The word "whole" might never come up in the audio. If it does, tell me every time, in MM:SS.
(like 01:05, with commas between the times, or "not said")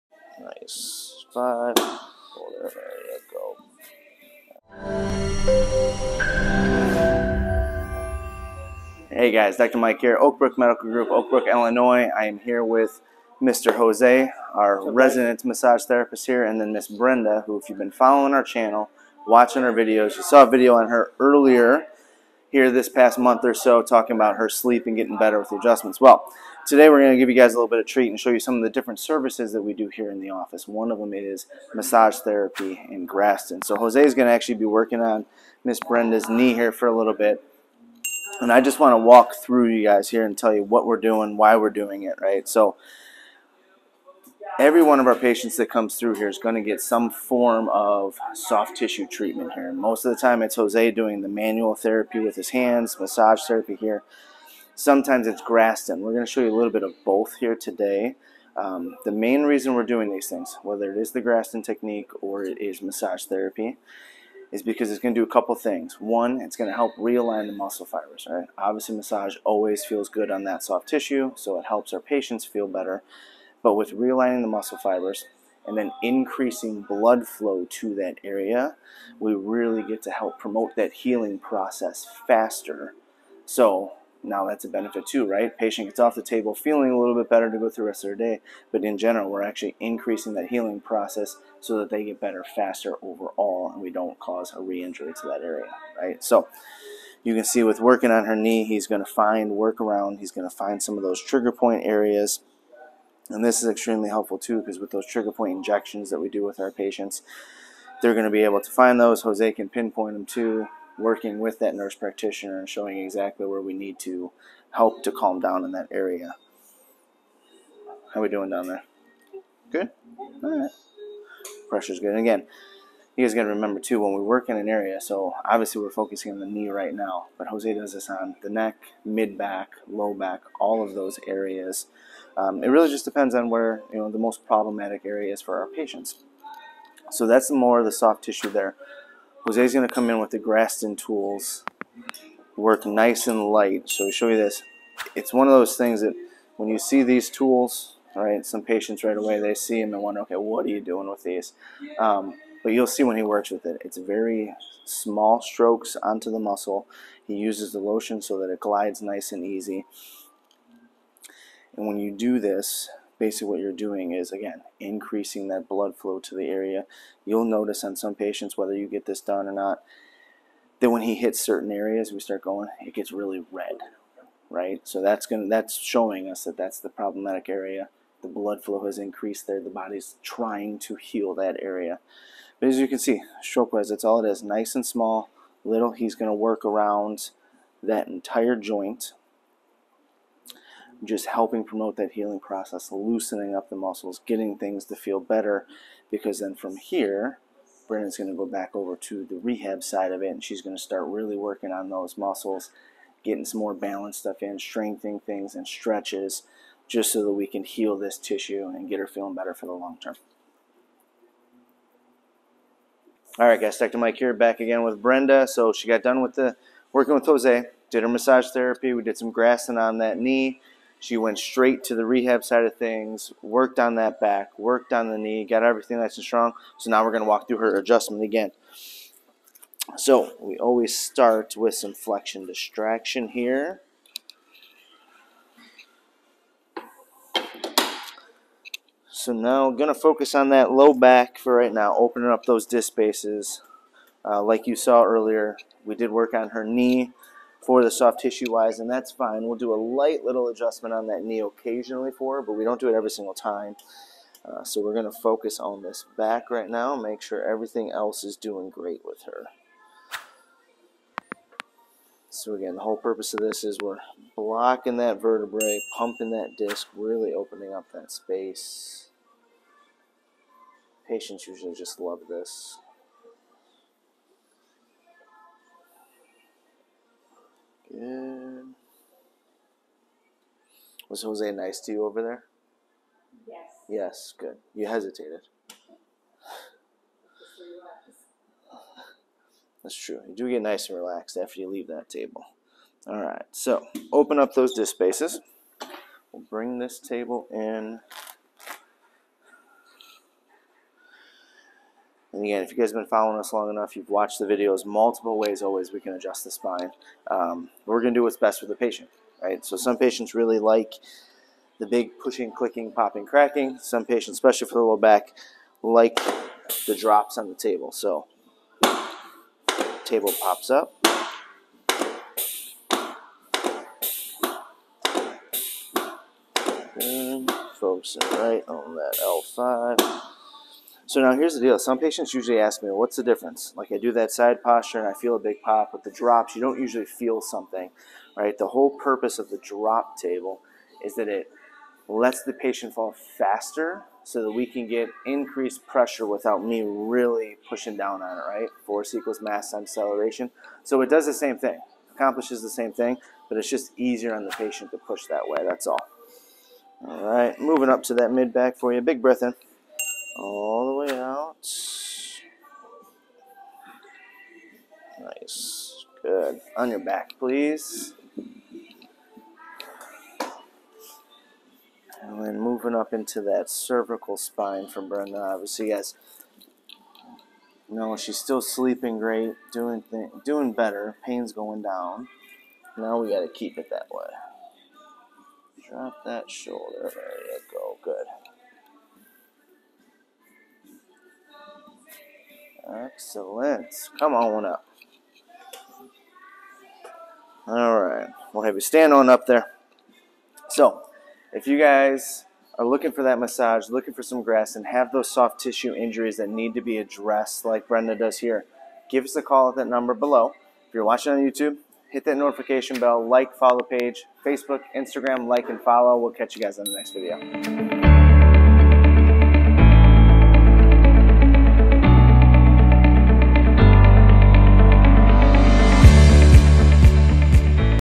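04:22, 05:38.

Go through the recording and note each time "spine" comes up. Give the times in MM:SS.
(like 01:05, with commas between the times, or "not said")
05:06, 06:14.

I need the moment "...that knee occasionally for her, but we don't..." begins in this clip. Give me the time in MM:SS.
04:11.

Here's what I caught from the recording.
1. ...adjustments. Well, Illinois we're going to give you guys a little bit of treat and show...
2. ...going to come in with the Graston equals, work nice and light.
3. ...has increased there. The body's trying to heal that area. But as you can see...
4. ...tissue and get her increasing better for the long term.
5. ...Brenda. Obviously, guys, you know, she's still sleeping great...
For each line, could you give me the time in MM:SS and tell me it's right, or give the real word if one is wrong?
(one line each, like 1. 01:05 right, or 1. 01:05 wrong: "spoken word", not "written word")
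1. 00:25 wrong: "Today", not "Illinois"
2. 02:19 wrong: "tools", not "equals"
3. 02:58 right
4. 03:28 wrong: "feeling", not "increasing"
5. 06:15 right.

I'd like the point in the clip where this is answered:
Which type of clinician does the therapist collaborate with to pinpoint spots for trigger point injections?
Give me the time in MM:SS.
01:51.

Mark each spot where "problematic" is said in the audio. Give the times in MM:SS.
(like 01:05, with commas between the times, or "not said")
02:14, 02:56.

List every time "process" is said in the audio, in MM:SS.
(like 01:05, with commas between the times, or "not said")
01:21, 01:30, 03:12.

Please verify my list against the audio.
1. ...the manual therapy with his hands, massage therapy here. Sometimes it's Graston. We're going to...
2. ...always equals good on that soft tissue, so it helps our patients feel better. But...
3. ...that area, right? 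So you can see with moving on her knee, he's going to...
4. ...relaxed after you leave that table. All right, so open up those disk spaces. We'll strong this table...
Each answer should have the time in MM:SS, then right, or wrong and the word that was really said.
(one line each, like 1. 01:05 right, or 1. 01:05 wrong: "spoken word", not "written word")
1. 00:51 right
2. 01:09 wrong: "feels", not "equals"
3. 01:35 wrong: "working", not "moving"
4. 04:50 wrong: "bring", not "strong".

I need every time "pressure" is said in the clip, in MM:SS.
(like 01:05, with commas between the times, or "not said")
02:01, 05:45.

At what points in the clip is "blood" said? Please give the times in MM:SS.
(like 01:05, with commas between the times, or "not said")
01:16, 02:45, 02:58.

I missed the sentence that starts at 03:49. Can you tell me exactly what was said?
So we always start with some flexion distraction here.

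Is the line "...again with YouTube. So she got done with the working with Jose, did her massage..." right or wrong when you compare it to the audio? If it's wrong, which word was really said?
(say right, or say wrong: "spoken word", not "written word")
wrong: "Brenda", not "YouTube".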